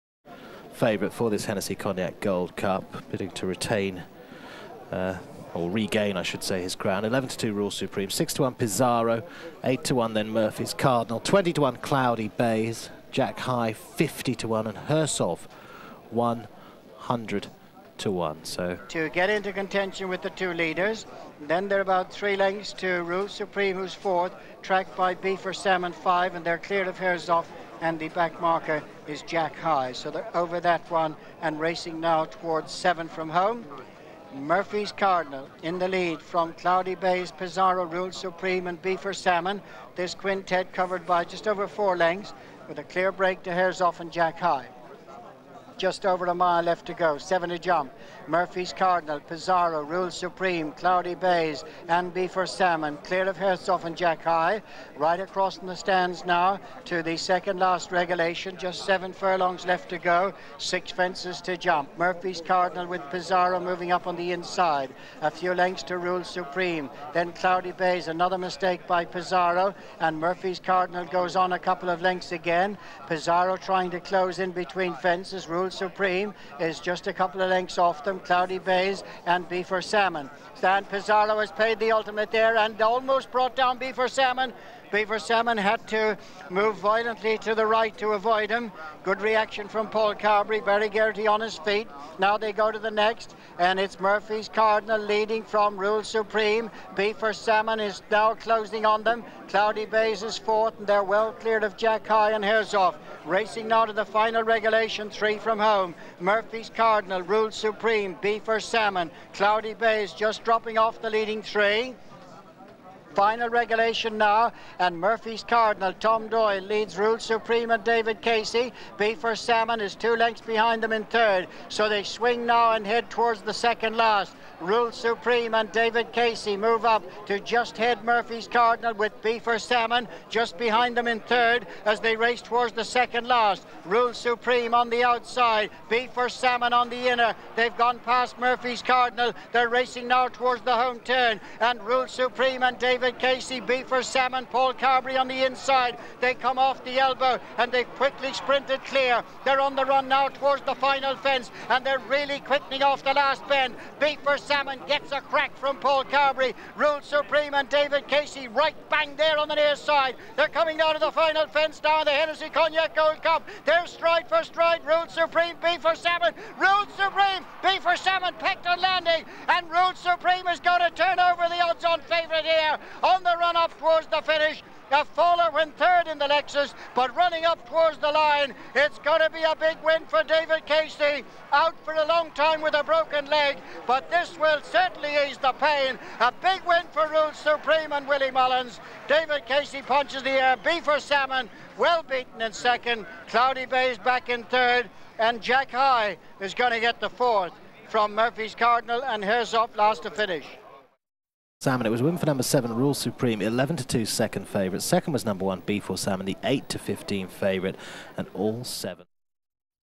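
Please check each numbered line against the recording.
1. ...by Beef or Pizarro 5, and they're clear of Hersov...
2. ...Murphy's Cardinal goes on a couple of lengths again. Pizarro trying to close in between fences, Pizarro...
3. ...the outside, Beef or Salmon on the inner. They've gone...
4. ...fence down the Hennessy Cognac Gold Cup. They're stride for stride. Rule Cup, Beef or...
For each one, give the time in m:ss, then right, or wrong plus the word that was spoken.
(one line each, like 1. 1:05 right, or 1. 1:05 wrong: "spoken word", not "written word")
1. 0:24 wrong: "Salmon", not "Pizarro"
2. 1:10 wrong: "Rule", not "Pizarro"
3. 2:14 right
4. 2:41 wrong: "Supreme", not "Cup".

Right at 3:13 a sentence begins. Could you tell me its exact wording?
Cloudy Bays back in third, and Jack High is going to get the fourth from Murphy's Cardinal, and Hersov last to finish.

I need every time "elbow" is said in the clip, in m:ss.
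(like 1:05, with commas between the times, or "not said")
2:26.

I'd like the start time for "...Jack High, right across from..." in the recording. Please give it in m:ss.
0:53.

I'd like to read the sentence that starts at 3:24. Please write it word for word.
Second was number one, Beef or Salmon, the 8 to 15 favourite, and all seven.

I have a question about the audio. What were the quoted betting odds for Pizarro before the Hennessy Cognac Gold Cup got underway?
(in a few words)
6 to 1.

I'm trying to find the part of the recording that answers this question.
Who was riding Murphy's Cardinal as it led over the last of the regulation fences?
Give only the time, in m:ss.
1:55.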